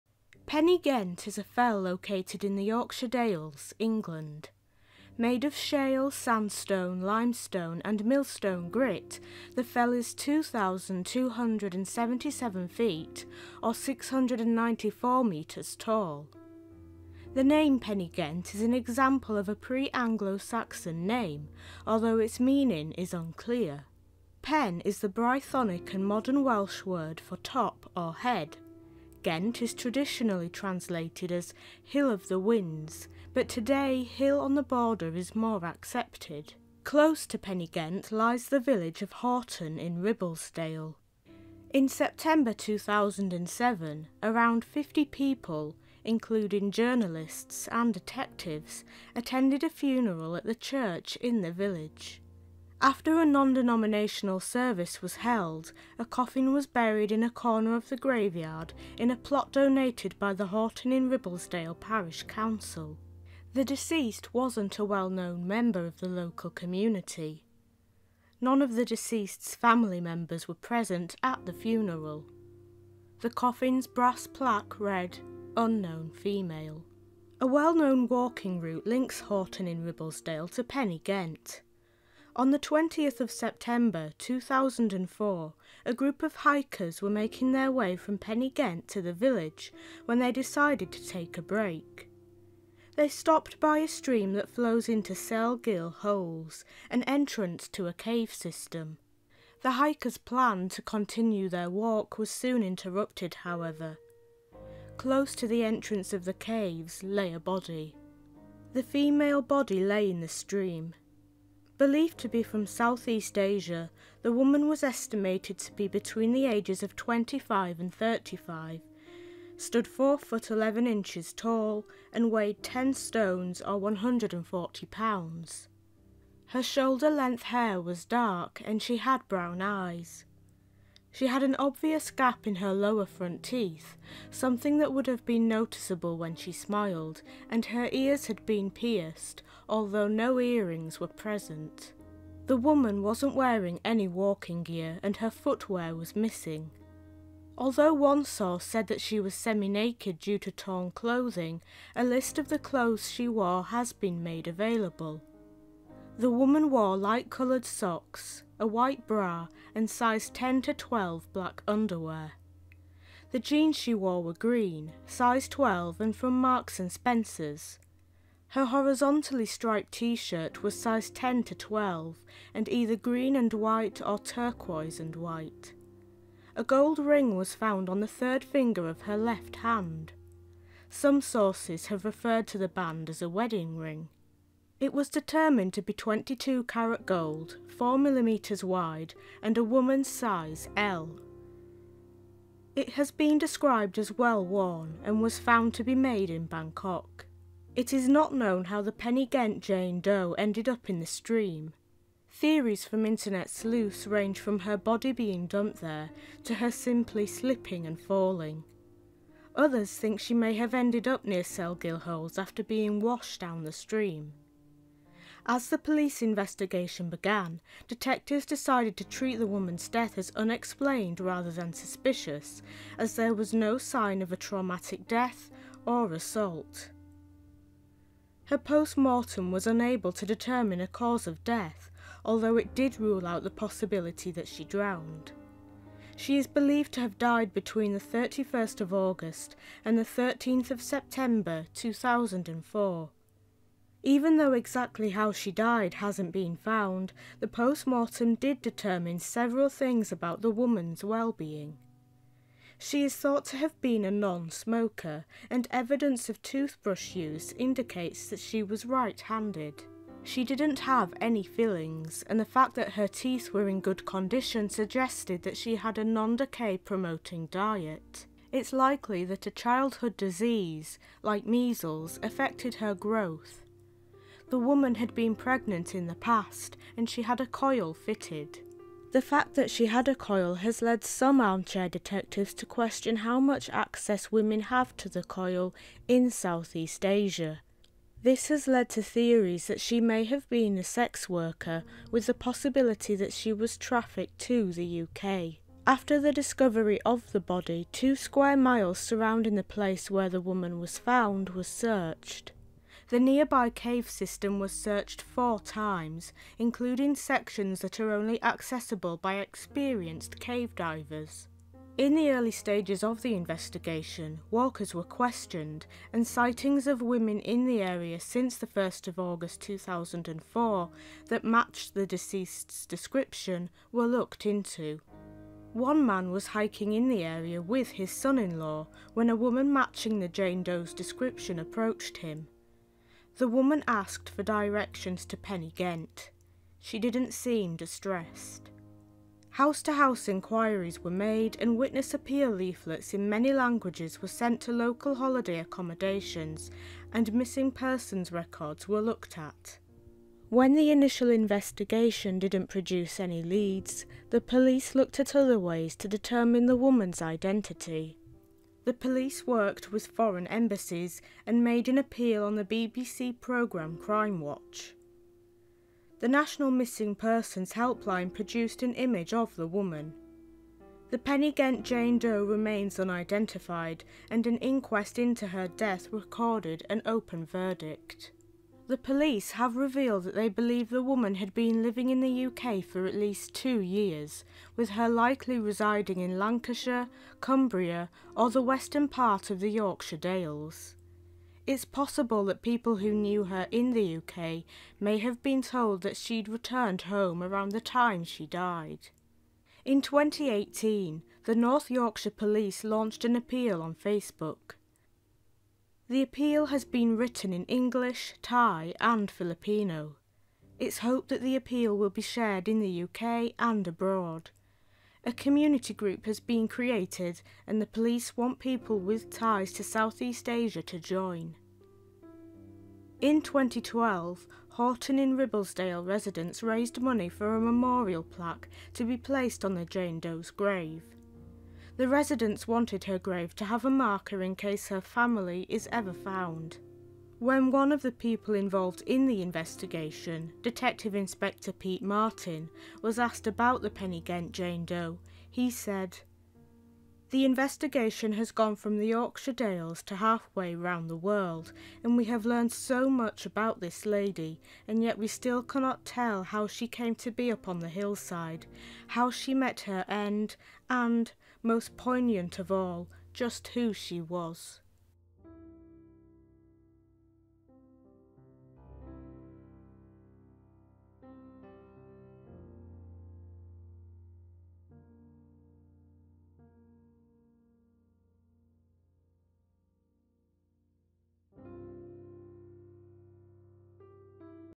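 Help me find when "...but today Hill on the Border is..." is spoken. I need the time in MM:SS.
00:33.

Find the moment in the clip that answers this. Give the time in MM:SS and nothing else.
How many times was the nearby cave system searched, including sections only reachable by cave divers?
05:05.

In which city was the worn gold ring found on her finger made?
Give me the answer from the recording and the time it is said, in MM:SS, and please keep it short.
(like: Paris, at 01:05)
Bangkok, at 03:16.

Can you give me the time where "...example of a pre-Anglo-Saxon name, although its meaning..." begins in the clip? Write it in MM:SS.
00:18.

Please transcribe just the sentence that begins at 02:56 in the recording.
A gold ring was found on the third finger of her left hand.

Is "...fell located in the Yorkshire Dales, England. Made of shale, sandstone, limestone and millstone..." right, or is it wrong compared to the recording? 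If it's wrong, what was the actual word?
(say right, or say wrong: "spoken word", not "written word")
right.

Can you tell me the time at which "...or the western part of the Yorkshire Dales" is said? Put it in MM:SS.
06:28.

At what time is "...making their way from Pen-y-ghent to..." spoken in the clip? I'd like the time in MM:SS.
01:27.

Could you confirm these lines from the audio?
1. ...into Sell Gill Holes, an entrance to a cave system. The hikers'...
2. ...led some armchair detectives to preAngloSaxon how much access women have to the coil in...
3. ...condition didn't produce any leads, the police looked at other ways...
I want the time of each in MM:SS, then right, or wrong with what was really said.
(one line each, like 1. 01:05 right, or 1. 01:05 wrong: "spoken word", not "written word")
1. 01:34 right
2. 04:40 wrong: "question", not "preAngloSaxon"
3. 05:51 wrong: "investigation", not "condition".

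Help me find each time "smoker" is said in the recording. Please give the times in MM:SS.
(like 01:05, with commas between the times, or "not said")
04:14.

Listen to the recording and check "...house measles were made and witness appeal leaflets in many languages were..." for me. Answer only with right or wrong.
wrong.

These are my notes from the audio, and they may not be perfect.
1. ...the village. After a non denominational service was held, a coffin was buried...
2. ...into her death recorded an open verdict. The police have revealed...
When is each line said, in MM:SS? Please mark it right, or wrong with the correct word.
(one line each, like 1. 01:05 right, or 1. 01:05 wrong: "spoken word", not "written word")
1. 00:51 right
2. 06:15 right.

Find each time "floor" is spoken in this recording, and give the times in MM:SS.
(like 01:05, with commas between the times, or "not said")
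not said.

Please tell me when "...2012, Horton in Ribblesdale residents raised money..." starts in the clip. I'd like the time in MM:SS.
07:03.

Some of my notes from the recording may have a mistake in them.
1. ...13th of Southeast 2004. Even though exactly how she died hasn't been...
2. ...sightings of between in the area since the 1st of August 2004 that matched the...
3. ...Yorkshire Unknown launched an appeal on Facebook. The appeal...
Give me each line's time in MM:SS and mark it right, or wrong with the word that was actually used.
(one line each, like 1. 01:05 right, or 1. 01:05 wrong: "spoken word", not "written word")
1. 04:00 wrong: "September", not "Southeast"
2. 05:16 wrong: "women", not "between"
3. 06:41 wrong: "Police", not "Unknown".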